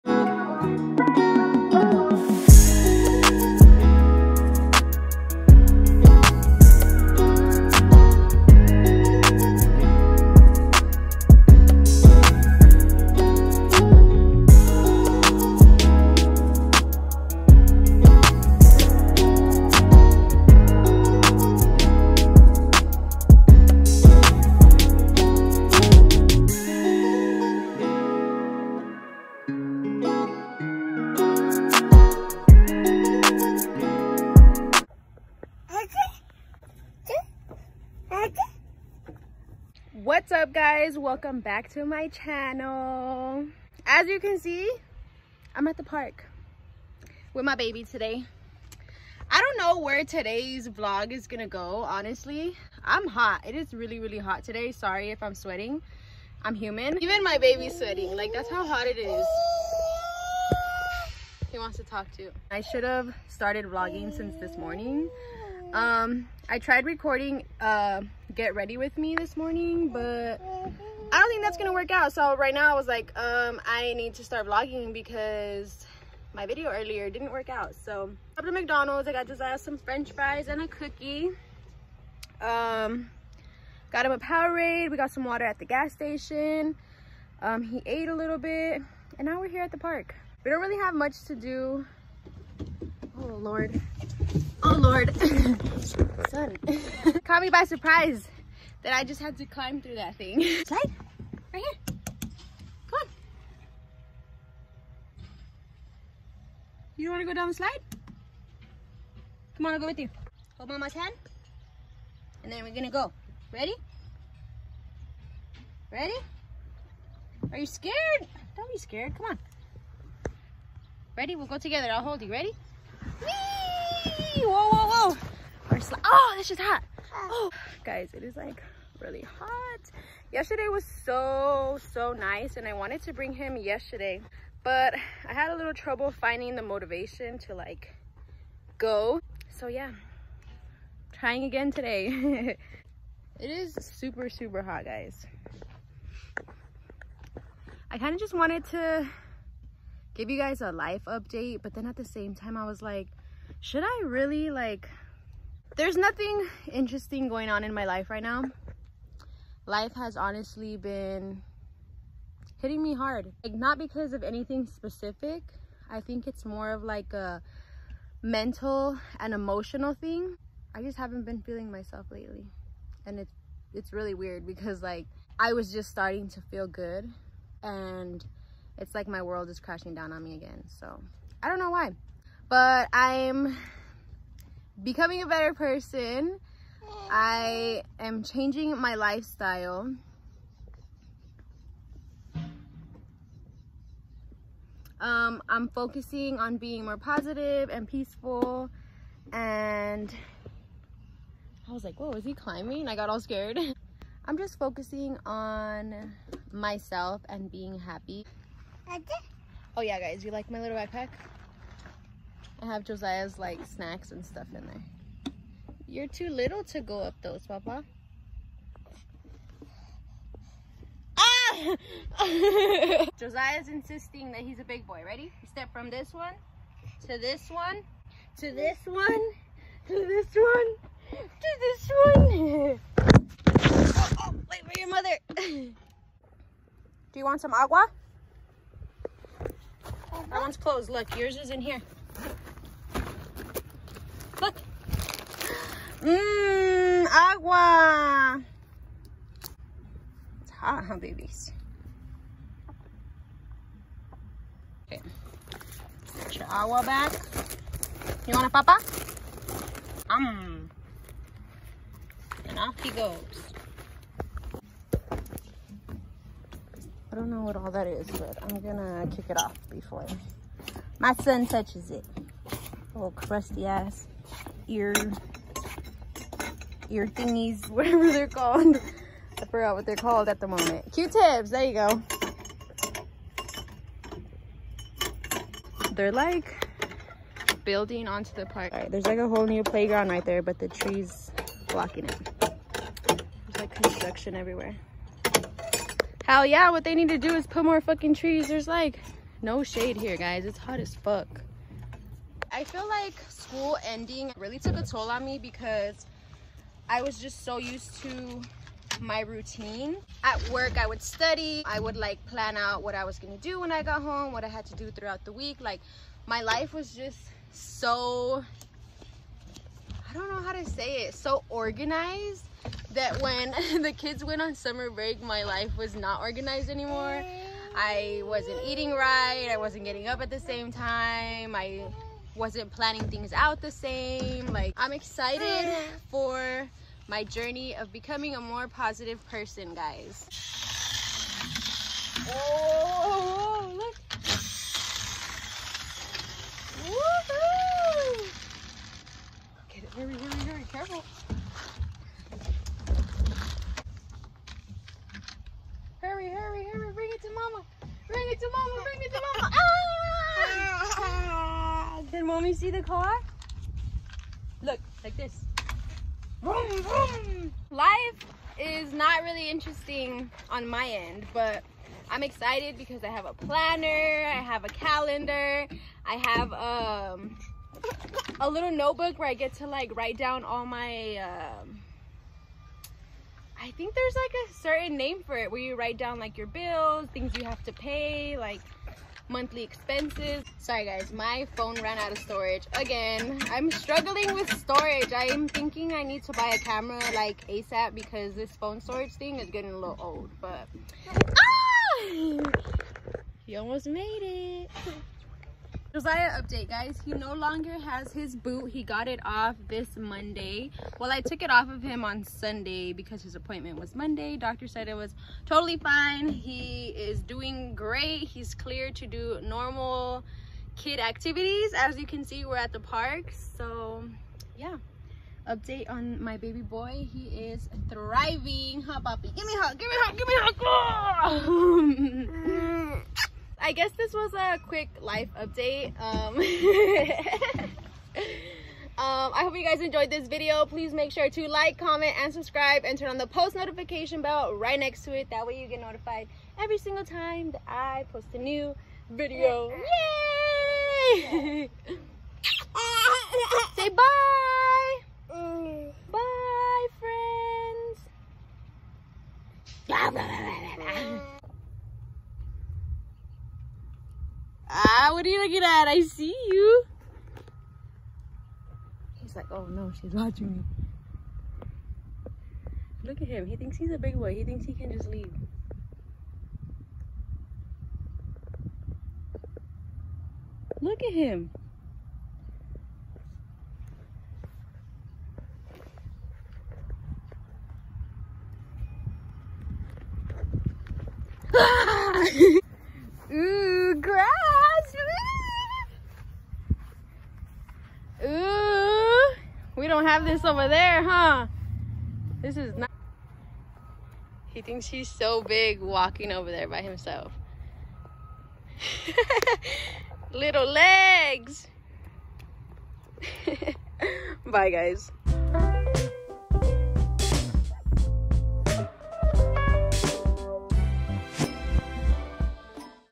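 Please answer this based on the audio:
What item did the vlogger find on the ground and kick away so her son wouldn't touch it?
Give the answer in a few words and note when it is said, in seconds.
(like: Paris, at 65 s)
Q-tips, at 280 s.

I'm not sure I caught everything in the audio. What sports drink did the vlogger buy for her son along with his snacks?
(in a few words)
Powerade.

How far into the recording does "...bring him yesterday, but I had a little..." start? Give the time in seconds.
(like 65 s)
133 s.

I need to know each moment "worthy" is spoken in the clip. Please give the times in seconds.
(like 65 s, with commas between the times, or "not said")
not said.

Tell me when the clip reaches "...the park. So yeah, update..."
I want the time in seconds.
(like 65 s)
422 s.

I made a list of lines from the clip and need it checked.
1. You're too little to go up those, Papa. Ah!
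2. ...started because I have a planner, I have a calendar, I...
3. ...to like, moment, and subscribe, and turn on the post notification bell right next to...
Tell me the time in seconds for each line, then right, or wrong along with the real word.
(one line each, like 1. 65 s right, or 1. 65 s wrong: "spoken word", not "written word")
1. 215 s right
2. 372 s wrong: "excited", not "started"
3. 441 s wrong: "comment", not "moment".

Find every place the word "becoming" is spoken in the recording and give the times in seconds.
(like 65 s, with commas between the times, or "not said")
184 s, 337 s.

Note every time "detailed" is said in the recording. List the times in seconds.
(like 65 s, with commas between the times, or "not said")
not said.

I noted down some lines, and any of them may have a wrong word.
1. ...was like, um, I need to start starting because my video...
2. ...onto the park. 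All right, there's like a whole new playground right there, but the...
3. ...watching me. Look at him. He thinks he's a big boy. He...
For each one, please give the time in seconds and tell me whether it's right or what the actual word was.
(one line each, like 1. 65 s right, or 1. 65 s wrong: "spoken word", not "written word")
1. 72 s wrong: "vlogging", not "starting"
2. 288 s right
3. 470 s right.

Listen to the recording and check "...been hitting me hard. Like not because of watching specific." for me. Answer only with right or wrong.
wrong.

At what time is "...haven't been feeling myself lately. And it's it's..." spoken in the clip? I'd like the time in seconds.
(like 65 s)
170 s.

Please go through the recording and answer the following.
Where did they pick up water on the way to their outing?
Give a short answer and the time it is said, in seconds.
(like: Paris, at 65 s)
the gas station, at 85 s.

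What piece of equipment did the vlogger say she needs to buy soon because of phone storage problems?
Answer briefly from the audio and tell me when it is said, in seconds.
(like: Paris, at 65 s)
a camera, at 396 s.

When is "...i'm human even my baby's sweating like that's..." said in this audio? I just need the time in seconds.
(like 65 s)
56 s.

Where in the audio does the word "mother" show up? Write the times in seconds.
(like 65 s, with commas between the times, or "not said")
234 s.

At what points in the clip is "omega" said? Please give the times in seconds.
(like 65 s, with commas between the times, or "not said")
not said.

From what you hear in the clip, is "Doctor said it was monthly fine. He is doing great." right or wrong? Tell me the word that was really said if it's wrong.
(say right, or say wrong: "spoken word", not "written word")
wrong: "totally", not "monthly".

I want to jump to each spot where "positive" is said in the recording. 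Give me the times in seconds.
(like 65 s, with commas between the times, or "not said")
196 s, 338 s.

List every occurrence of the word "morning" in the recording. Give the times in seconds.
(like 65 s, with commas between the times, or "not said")
64 s, 69 s.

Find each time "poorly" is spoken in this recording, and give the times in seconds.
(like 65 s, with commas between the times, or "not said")
not said.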